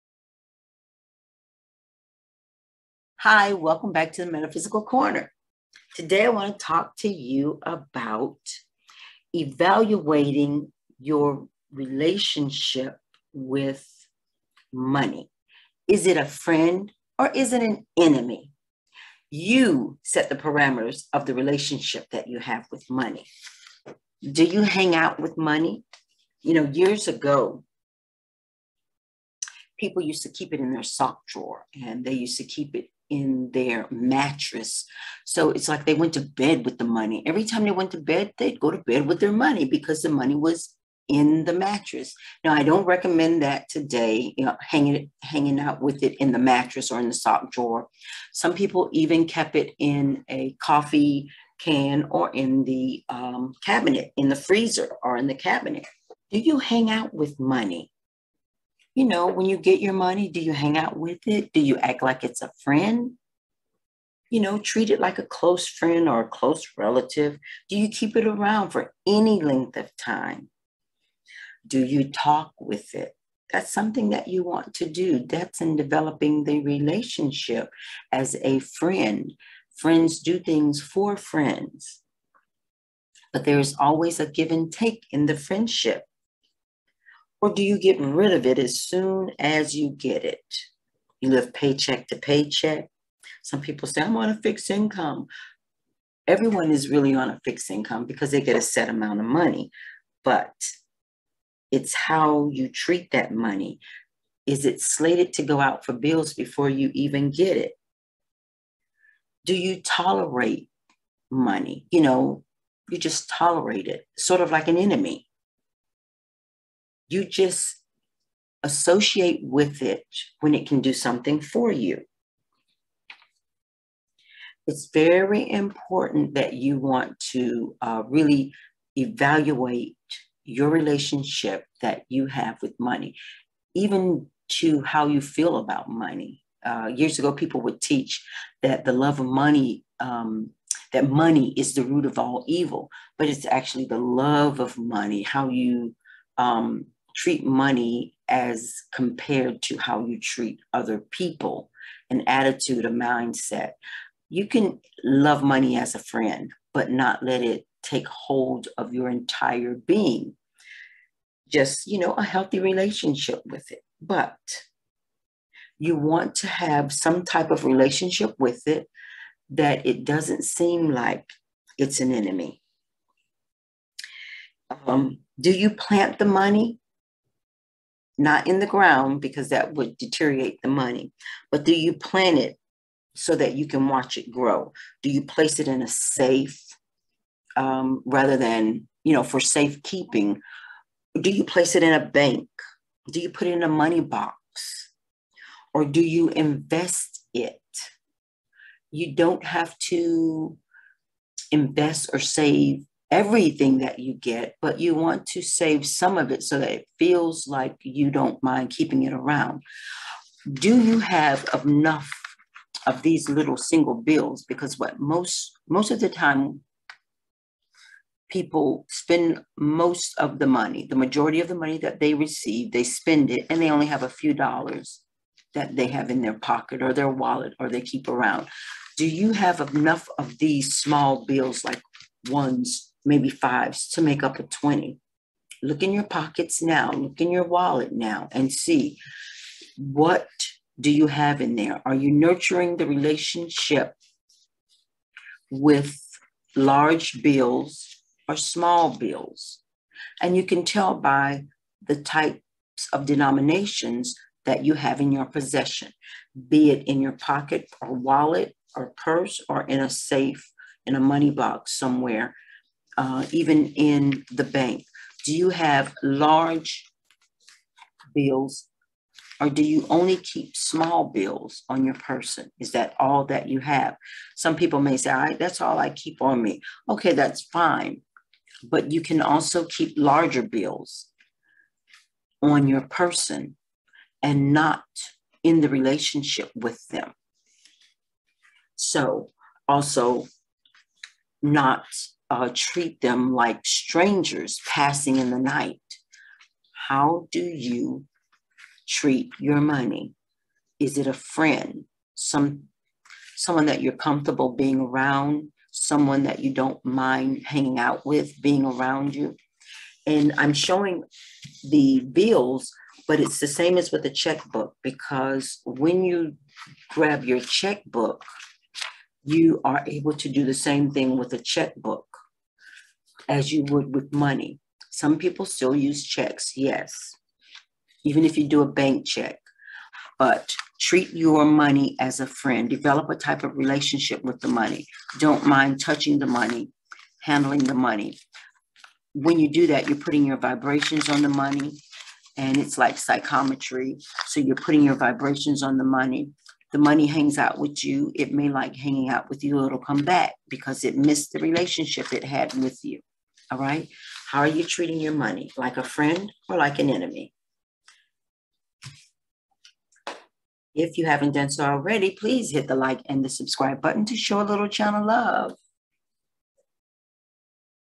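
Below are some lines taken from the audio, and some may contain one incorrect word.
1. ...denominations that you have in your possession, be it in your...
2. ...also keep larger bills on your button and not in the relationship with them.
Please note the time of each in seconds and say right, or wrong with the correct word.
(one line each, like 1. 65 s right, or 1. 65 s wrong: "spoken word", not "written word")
1. 253 s right
2. 279 s wrong: "person", not "button".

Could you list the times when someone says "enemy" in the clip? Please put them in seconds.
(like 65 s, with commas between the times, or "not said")
17 s, 114 s, 172 s, 356 s.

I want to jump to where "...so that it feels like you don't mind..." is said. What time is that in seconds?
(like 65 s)
206 s.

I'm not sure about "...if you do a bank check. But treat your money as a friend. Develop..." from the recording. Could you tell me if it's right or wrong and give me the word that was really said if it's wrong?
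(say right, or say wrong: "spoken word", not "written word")
right.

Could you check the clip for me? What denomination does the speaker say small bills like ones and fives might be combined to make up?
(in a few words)
20.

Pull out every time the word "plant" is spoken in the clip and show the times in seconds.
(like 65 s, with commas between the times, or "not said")
175 s, 181 s.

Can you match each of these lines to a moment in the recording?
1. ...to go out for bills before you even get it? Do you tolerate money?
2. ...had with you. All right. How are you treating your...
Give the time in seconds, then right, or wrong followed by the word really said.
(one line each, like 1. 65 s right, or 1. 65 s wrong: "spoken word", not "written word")
1. 105 s right
2. 352 s right.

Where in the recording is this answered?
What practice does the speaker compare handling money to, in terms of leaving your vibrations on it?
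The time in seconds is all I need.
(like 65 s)
342 s.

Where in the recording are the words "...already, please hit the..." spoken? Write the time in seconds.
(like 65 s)
361 s.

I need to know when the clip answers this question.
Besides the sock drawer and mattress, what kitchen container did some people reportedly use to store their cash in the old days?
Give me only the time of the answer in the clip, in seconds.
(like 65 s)
50 s.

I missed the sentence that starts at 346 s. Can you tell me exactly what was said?
The money hangs out with you.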